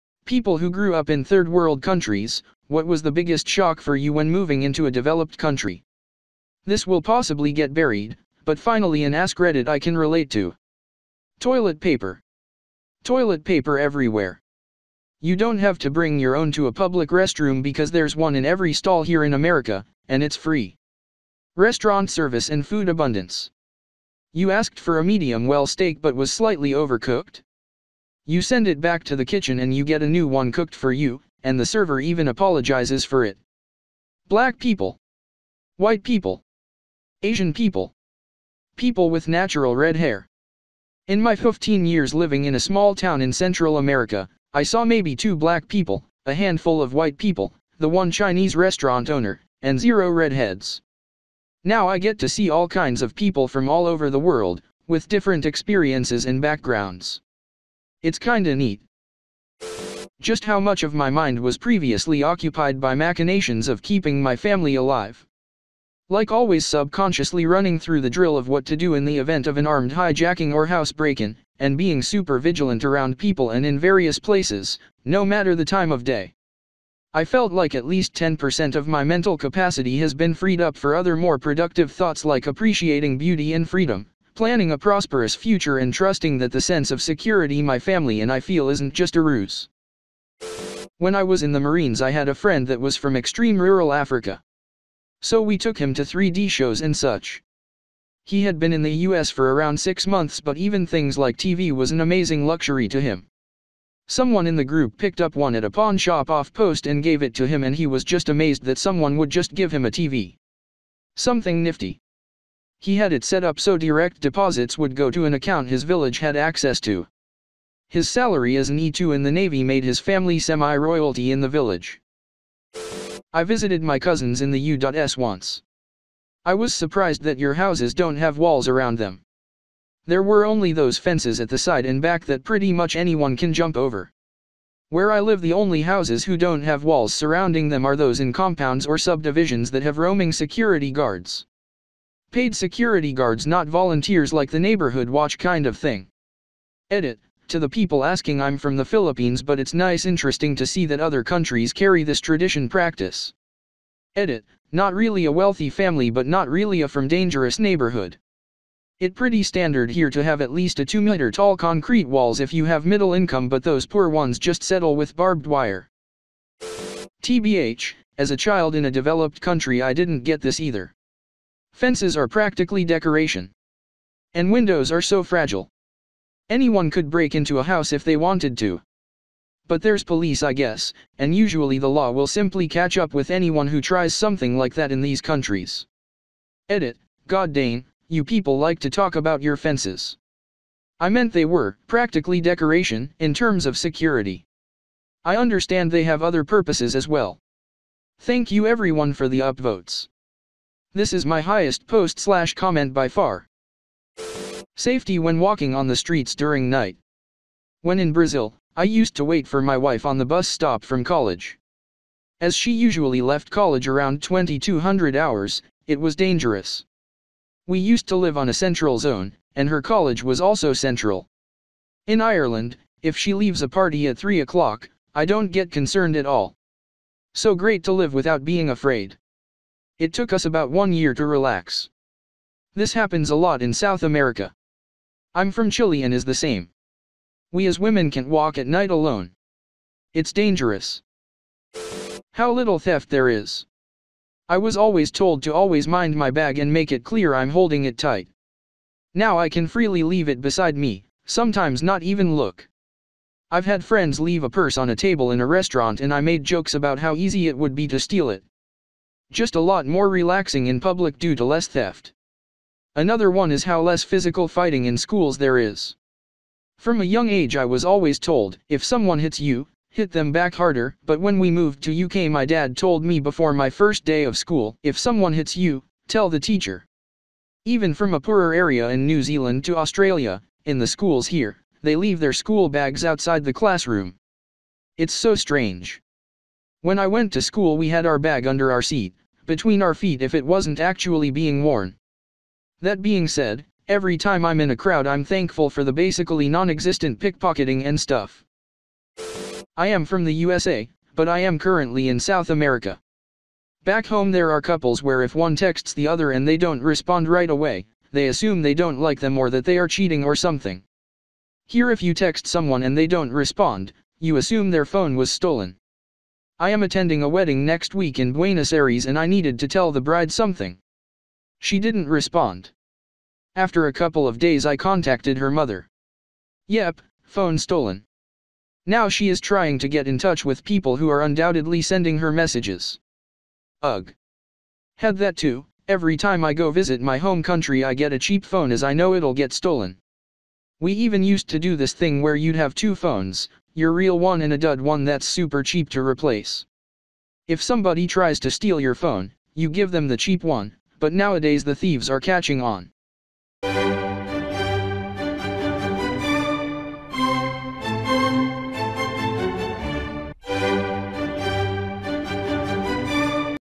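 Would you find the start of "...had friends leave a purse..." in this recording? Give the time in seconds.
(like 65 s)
253 s.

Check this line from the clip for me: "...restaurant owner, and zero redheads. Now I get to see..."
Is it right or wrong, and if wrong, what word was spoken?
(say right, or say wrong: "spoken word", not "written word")
right.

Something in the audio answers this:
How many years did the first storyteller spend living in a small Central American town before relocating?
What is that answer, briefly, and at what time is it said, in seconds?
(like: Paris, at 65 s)
15, at 41 s.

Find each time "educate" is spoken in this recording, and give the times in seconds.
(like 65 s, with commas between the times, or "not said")
not said.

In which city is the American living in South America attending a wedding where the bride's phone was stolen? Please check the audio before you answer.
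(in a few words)
Buenos Aires.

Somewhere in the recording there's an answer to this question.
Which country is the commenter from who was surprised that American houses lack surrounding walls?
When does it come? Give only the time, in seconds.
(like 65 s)
148 s.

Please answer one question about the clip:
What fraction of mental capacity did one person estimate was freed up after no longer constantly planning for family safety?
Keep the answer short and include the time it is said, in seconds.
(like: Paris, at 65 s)
10%, at 78 s.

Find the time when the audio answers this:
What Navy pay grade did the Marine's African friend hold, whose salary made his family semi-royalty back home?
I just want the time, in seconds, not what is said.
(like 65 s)
118 s.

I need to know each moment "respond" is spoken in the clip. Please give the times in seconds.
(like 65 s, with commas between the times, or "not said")
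306 s, 313 s, 322 s.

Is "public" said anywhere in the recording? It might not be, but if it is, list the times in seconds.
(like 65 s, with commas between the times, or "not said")
16 s, 260 s.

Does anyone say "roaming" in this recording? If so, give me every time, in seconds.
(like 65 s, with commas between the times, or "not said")
139 s.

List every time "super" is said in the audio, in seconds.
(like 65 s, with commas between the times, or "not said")
72 s, 345 s.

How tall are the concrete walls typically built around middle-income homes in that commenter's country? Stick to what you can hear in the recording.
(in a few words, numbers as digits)
2 meters.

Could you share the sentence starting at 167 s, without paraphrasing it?
TBH, as a child in a developed country I didn't get this either.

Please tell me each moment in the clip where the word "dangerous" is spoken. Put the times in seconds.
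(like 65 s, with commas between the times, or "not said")
157 s, 216 s, 240 s.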